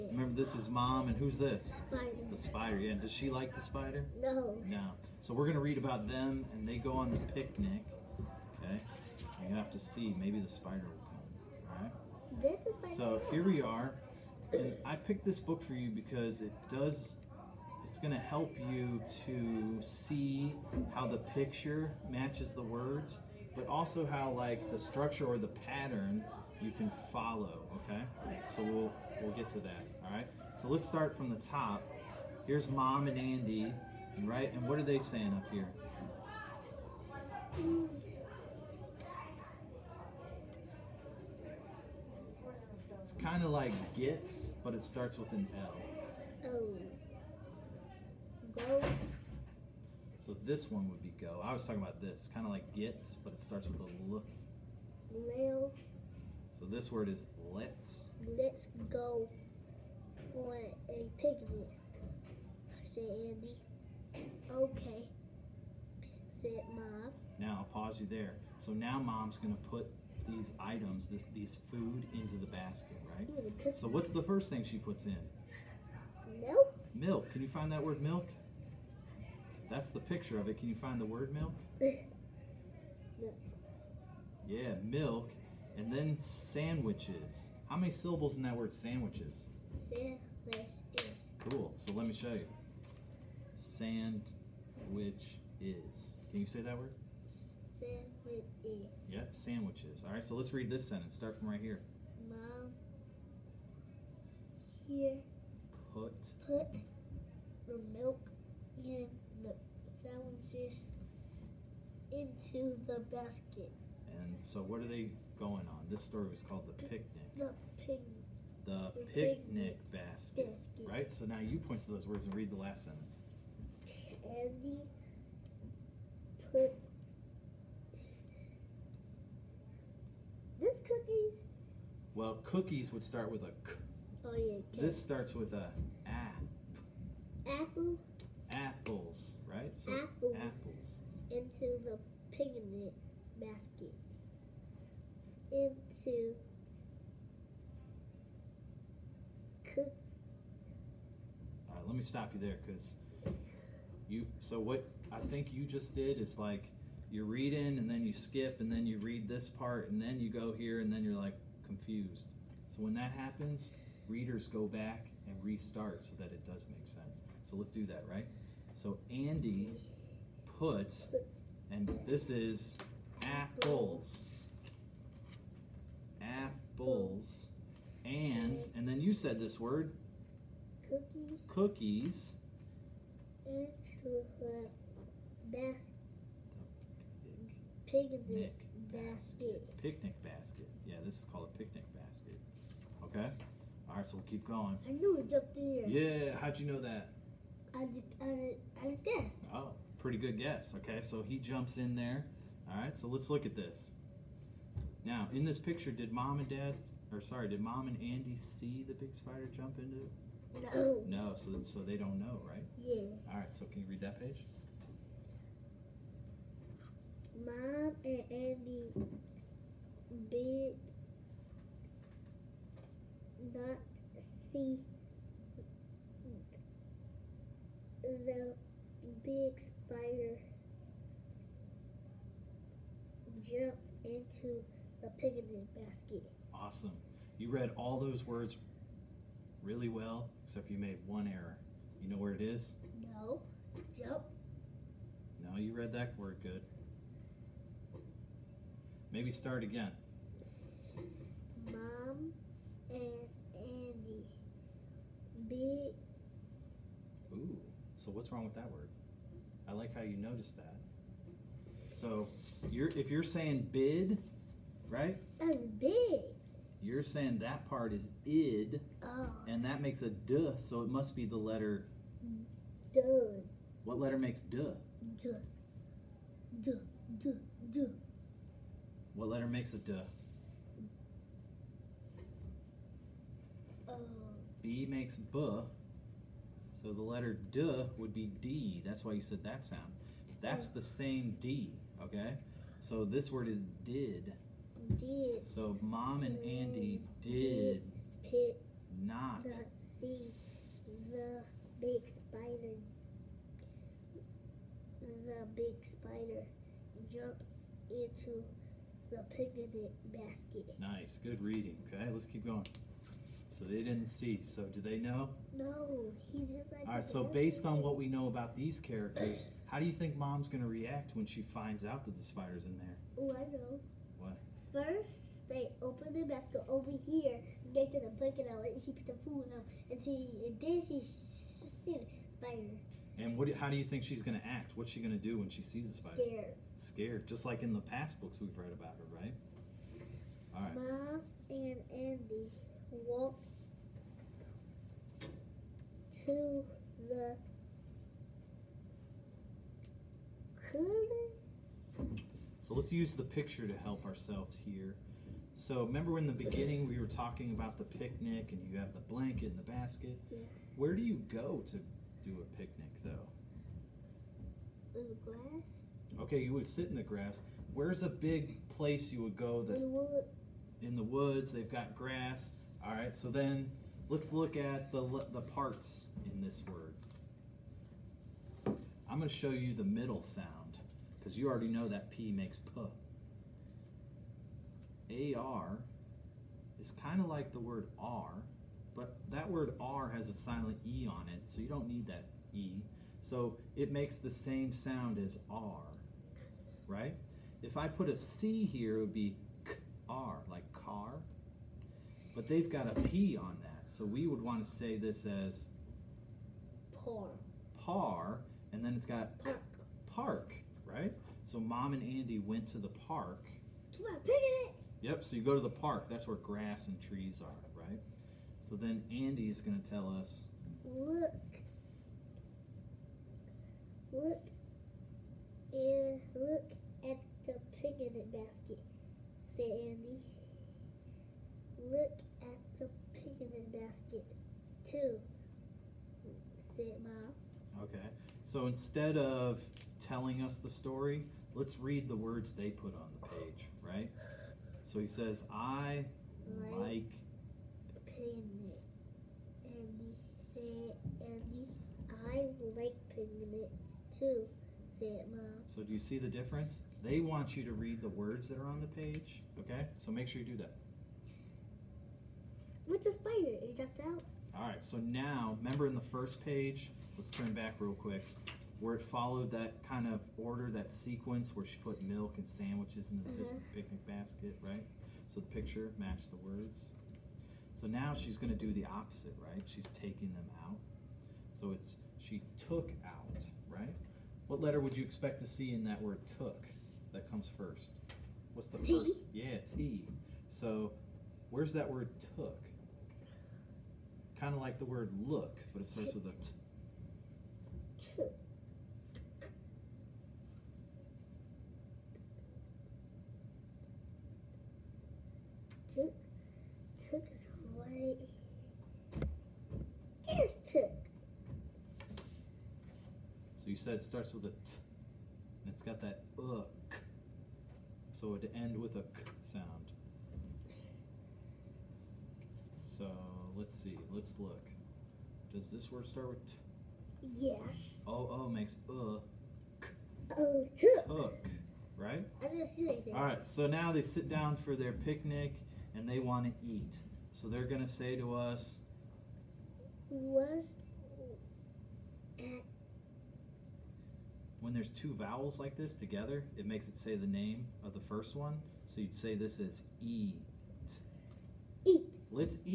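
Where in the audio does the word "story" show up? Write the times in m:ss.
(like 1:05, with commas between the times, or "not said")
1:56, 7:20.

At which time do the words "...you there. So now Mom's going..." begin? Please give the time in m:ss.
1:07.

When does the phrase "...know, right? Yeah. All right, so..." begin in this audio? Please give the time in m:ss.
3:32.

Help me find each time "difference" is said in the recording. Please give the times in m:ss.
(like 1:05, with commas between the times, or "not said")
7:36.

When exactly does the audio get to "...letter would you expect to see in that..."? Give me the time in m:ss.
8:04.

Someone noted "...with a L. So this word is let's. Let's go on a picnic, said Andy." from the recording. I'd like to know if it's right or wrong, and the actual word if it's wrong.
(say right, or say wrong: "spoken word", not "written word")
right.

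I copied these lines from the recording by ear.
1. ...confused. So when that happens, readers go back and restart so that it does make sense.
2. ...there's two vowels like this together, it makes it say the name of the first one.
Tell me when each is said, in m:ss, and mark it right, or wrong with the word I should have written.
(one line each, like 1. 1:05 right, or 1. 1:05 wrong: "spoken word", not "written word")
1. 2:41 right
2. 9:04 right.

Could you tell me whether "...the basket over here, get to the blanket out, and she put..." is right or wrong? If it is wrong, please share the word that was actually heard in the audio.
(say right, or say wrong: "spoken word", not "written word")
wrong: "bucket", not "blanket".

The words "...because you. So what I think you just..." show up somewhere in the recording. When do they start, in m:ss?
2:32.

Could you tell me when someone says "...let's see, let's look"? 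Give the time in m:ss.
8:43.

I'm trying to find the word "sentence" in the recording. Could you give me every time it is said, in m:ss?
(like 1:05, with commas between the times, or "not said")
1:40, 2:02.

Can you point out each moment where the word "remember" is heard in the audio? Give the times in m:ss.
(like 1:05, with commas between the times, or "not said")
0:00, 5:55, 7:45.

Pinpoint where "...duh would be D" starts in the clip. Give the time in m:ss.
4:47.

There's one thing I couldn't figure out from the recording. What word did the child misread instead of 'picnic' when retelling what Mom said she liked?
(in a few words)
pigment.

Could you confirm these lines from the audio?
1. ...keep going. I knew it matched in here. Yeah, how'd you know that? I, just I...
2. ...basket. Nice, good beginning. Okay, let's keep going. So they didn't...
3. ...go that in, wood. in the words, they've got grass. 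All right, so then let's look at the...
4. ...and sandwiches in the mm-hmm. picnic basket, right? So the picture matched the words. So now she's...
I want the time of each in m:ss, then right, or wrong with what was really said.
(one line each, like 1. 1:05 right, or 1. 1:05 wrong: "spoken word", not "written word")
1. 3:14 wrong: "jumped", not "matched"
2. 5:10 wrong: "reading", not "beginning"
3. 6:09 wrong: "woods", not "words"
4. 7:52 right.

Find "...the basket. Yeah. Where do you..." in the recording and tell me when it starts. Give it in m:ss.
5:59.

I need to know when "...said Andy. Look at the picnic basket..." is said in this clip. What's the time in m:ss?
7:09.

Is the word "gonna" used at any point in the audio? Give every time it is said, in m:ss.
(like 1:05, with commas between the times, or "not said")
0:05, 5:20.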